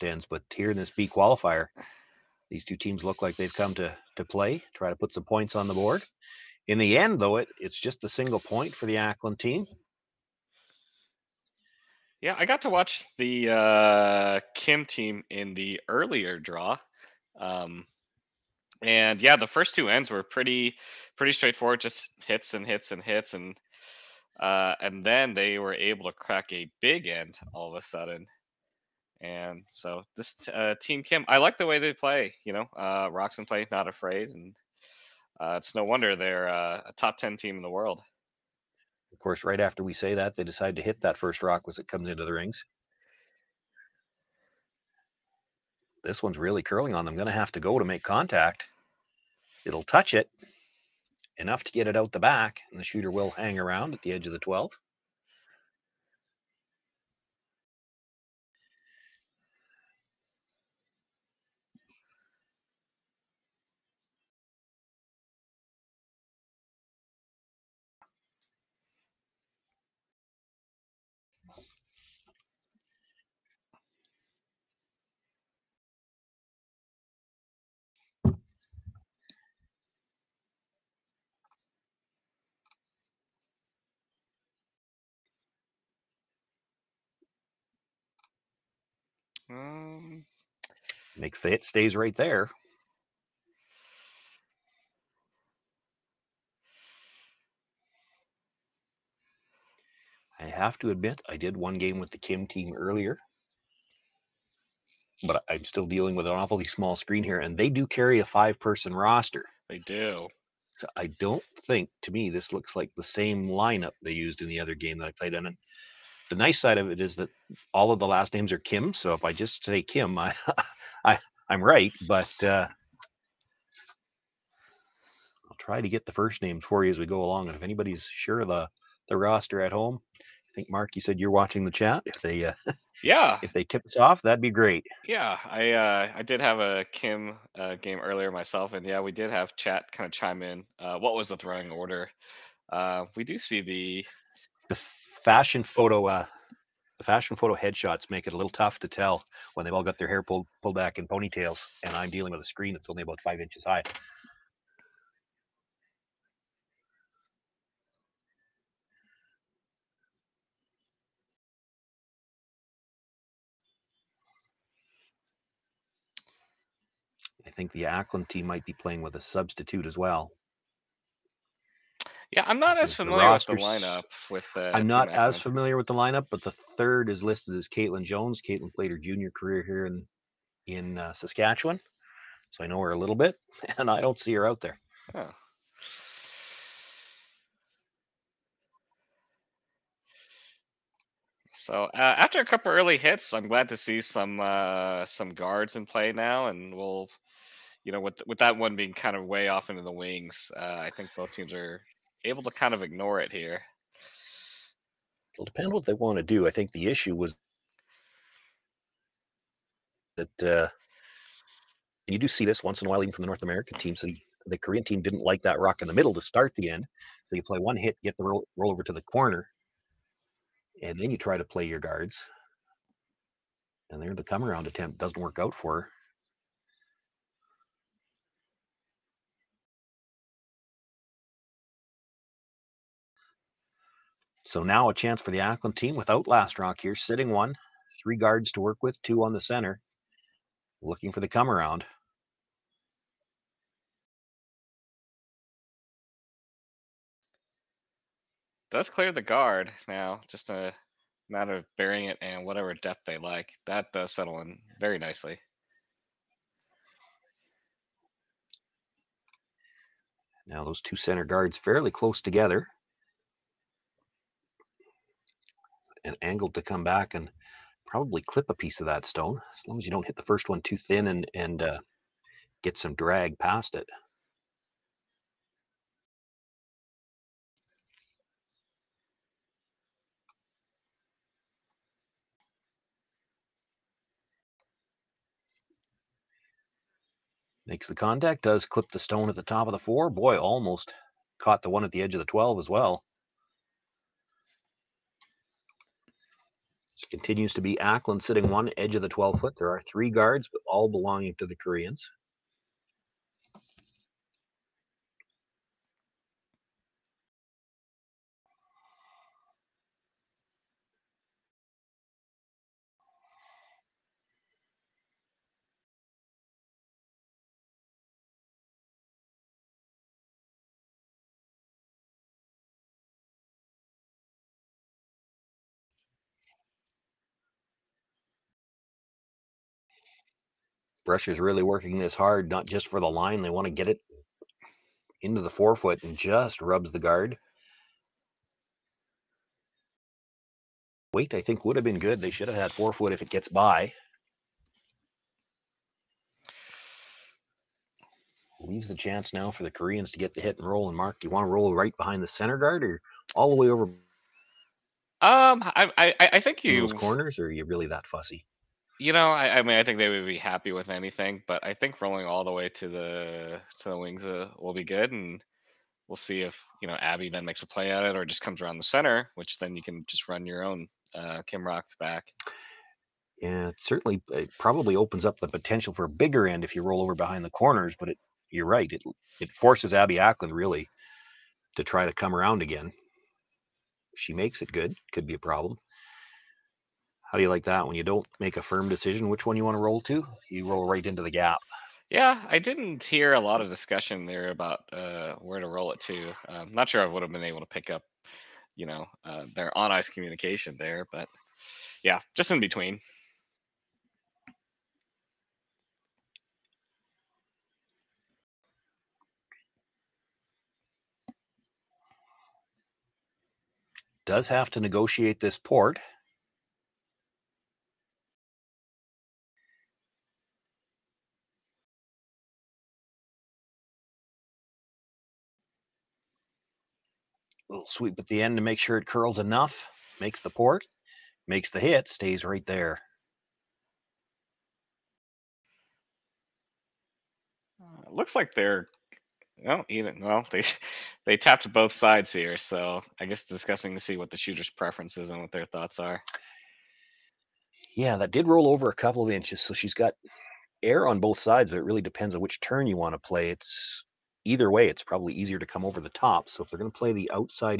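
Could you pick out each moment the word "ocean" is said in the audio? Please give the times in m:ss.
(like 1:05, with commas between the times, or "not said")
not said.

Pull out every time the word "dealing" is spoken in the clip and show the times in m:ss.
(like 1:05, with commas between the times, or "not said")
1:45, 2:32.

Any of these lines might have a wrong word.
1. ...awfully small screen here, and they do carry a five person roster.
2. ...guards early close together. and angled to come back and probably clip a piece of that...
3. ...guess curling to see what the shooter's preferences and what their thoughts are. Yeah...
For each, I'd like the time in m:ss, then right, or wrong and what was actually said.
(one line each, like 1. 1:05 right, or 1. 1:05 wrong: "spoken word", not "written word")
1. 1:46 right
2. 4:21 wrong: "fairly", not "early"
3. 7:23 wrong: "discussing", not "curling".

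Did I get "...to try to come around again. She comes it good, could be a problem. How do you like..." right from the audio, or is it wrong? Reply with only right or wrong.
wrong.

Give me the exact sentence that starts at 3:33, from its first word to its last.
So the, the Korean team didn't like that rock in the middle to start the end.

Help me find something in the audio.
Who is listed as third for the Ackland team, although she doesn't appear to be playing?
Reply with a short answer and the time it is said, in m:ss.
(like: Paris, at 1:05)
Caitlin Jones, at 2:57.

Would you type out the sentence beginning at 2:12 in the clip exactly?
If they uh, yeah, if they tip us off, that'd be great.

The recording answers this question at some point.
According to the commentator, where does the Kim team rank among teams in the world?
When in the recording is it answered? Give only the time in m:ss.
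0:36.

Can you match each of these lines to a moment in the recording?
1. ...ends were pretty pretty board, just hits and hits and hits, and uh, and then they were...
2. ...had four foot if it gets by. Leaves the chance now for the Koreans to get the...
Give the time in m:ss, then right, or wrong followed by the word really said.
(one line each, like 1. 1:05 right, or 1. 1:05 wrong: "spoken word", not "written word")
1. 0:19 wrong: "straightforward", not "board"
2. 5:42 right.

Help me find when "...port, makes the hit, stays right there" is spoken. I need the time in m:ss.
7:10.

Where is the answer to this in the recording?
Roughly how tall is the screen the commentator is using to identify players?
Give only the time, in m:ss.
2:33.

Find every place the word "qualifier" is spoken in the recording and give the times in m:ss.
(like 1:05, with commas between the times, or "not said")
0:01.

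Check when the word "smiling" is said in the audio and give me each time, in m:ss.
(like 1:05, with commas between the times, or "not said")
not said.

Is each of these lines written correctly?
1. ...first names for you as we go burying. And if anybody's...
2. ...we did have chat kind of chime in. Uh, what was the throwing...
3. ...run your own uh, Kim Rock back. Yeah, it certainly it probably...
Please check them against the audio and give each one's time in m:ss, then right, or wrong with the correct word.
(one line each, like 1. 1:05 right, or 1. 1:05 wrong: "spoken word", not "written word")
1. 2:06 wrong: "along", not "burying"
2. 2:18 right
3. 6:10 right.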